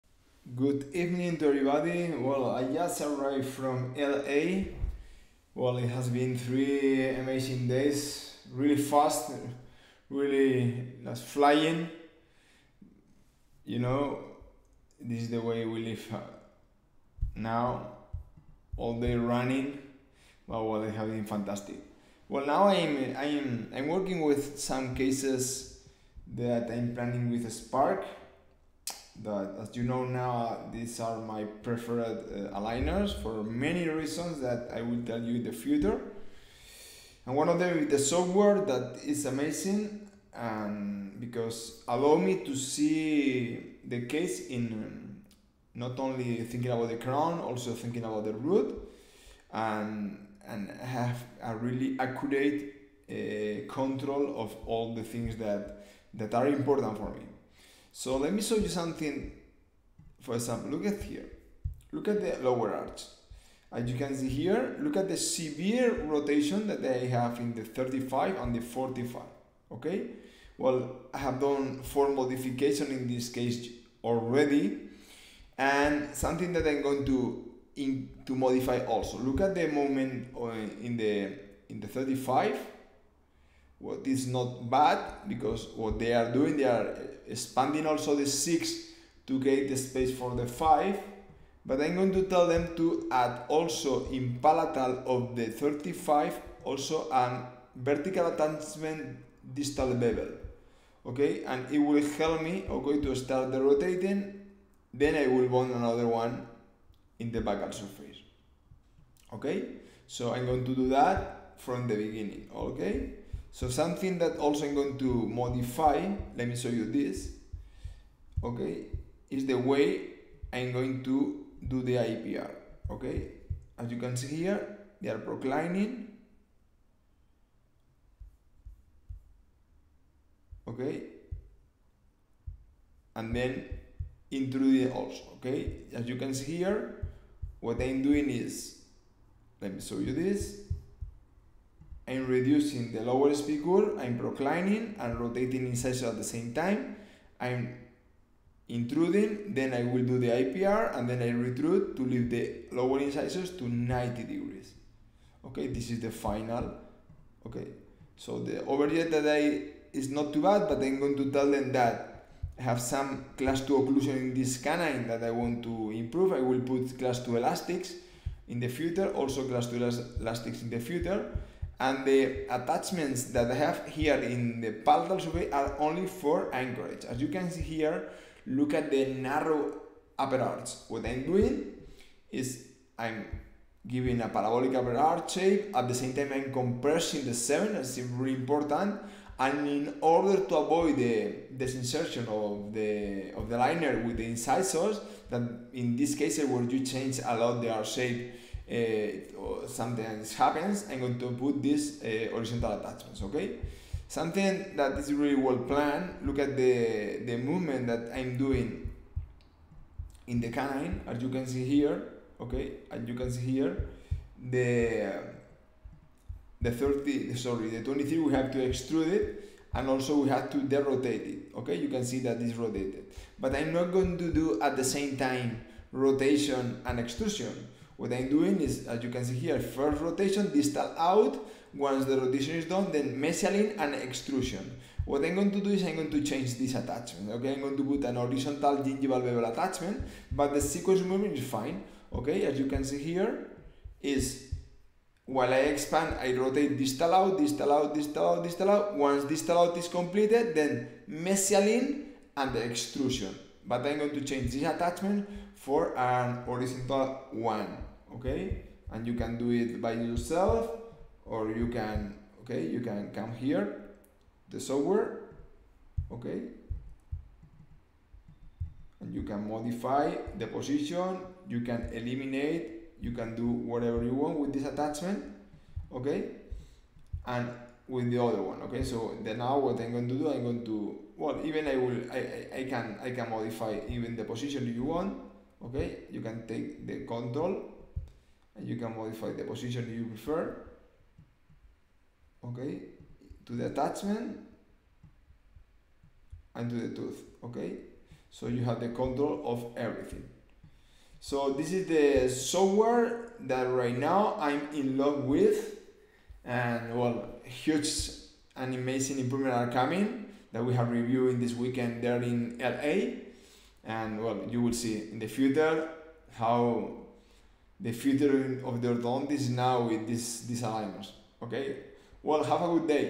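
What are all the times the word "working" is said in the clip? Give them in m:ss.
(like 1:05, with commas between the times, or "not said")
0:23.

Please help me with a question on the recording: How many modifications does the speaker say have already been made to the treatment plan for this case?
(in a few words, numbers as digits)
4.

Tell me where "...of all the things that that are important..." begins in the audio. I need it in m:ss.
0:54.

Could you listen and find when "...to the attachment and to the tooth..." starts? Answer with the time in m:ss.
4:53.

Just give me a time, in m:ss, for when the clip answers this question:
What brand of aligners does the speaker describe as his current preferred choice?
0:27.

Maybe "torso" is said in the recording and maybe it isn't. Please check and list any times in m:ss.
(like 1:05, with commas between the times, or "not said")
not said.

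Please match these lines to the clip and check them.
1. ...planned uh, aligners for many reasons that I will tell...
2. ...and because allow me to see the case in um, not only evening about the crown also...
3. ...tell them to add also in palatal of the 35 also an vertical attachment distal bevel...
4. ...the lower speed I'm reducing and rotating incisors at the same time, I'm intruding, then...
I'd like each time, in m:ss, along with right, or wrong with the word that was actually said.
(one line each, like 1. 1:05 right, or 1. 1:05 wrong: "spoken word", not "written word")
1. 0:31 wrong: "preferred", not "planned"
2. 0:40 wrong: "thinking", not "evening"
3. 1:32 right
4. 2:22 wrong: "proclining", not "reducing".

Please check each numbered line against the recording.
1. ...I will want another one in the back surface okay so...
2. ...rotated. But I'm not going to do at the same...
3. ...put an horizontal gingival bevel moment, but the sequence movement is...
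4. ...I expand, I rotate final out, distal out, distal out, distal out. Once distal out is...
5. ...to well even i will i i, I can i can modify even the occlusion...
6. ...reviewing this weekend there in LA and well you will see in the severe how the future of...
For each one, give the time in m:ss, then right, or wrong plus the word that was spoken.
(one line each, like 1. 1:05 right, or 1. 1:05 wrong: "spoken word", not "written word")
1. 1:45 right
2. 3:42 right
3. 3:57 wrong: "attachment", not "moment"
4. 4:05 wrong: "distal", not "final"
5. 4:40 wrong: "position", not "occlusion"
6. 5:10 wrong: "future", not "severe".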